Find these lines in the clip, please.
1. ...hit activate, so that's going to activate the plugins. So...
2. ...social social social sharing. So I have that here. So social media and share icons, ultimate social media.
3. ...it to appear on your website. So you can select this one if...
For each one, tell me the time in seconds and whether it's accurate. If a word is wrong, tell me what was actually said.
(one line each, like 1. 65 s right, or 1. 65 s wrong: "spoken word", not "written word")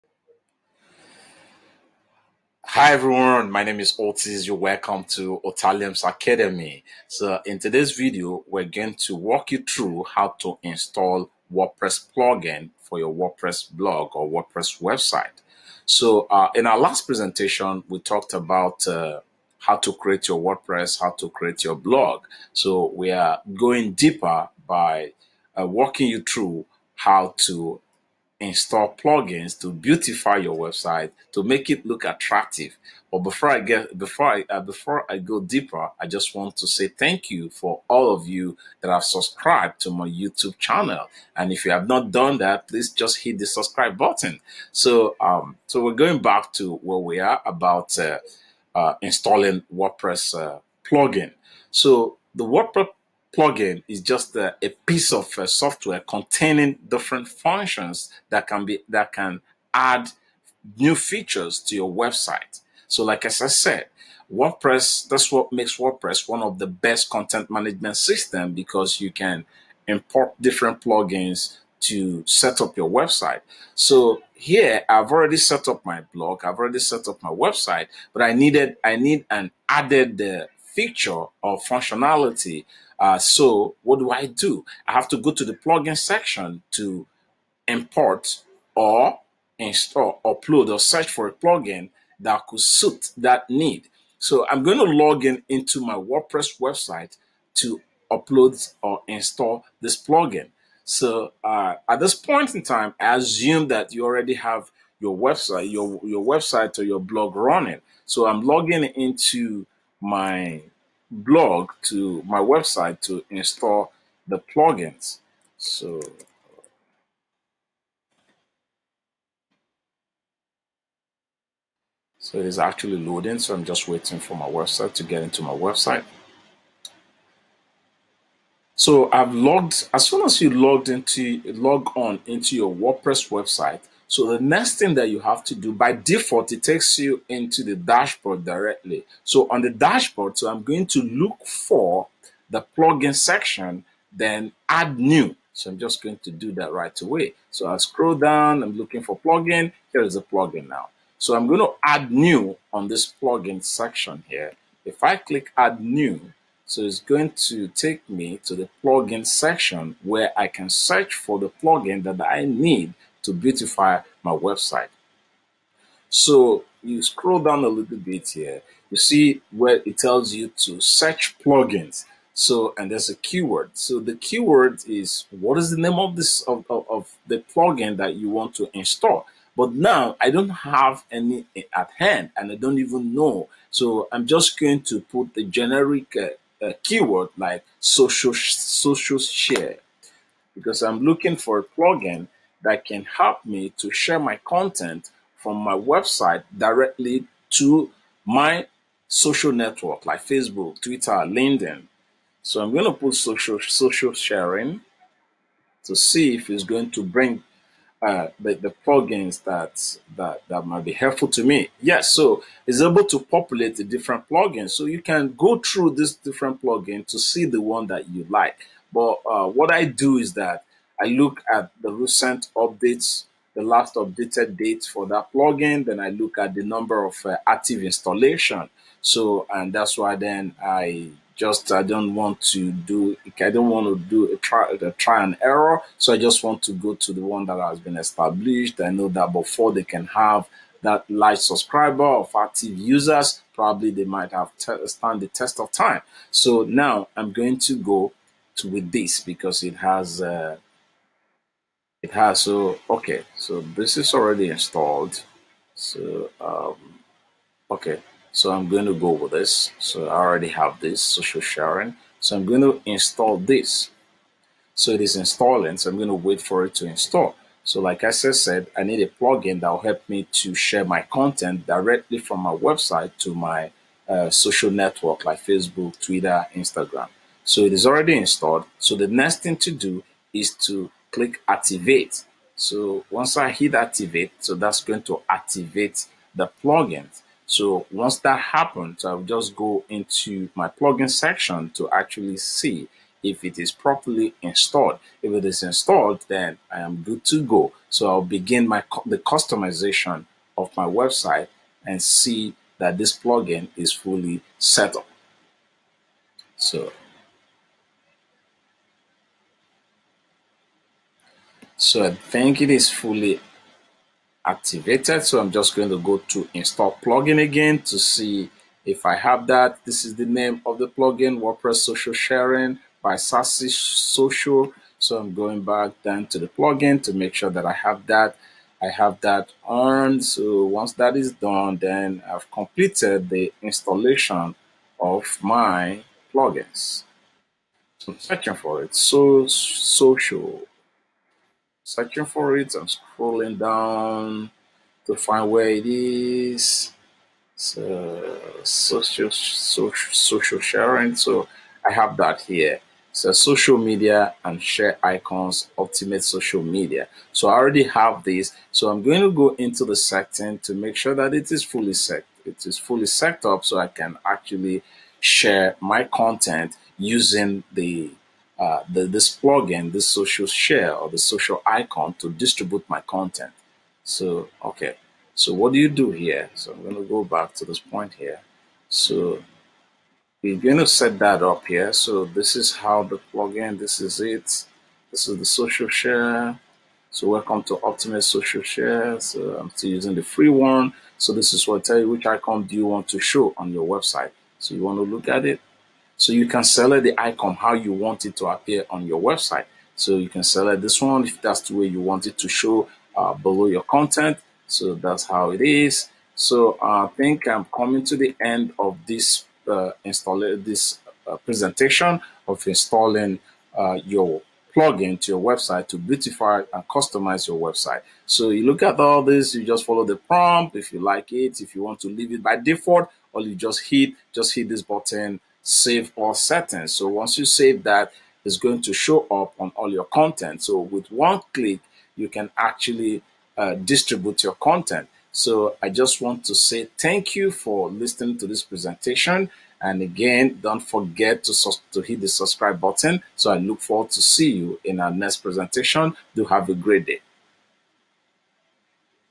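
1. 283 s right
2. 348 s right
3. 398 s right.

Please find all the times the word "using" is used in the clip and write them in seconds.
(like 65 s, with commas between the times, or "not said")
366 s, 389 s.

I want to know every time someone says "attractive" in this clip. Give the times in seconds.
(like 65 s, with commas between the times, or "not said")
32 s.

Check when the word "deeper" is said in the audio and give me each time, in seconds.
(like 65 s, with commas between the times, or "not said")
23 s, 35 s.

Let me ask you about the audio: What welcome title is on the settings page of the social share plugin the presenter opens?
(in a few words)
Optimus Social Share.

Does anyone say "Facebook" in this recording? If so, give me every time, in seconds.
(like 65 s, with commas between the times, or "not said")
200 s, 275 s.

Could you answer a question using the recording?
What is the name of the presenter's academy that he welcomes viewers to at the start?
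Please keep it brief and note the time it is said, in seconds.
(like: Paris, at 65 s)
Otalium's Academy, at 5 s.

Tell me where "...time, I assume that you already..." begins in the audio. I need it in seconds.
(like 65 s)
102 s.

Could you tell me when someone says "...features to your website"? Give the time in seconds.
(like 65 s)
60 s.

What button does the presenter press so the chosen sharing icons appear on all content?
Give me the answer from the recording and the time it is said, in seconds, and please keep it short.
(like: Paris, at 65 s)
save all settings, at 425 s.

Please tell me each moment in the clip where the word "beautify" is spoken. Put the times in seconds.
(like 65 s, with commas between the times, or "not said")
29 s, 163 s, 415 s.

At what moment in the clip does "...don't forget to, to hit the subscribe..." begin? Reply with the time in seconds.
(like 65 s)
440 s.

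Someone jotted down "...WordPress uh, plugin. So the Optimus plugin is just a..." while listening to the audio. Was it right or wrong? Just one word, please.
wrong.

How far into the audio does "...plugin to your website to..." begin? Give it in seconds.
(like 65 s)
414 s.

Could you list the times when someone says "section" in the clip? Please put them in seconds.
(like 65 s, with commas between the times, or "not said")
85 s, 143 s, 153 s, 159 s, 291 s.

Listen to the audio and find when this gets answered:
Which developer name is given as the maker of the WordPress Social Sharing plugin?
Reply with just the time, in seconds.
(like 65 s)
323 s.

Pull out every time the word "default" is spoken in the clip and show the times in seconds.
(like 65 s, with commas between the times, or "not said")
135 s, 422 s.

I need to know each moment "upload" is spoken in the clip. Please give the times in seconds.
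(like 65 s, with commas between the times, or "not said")
90 s, 98 s.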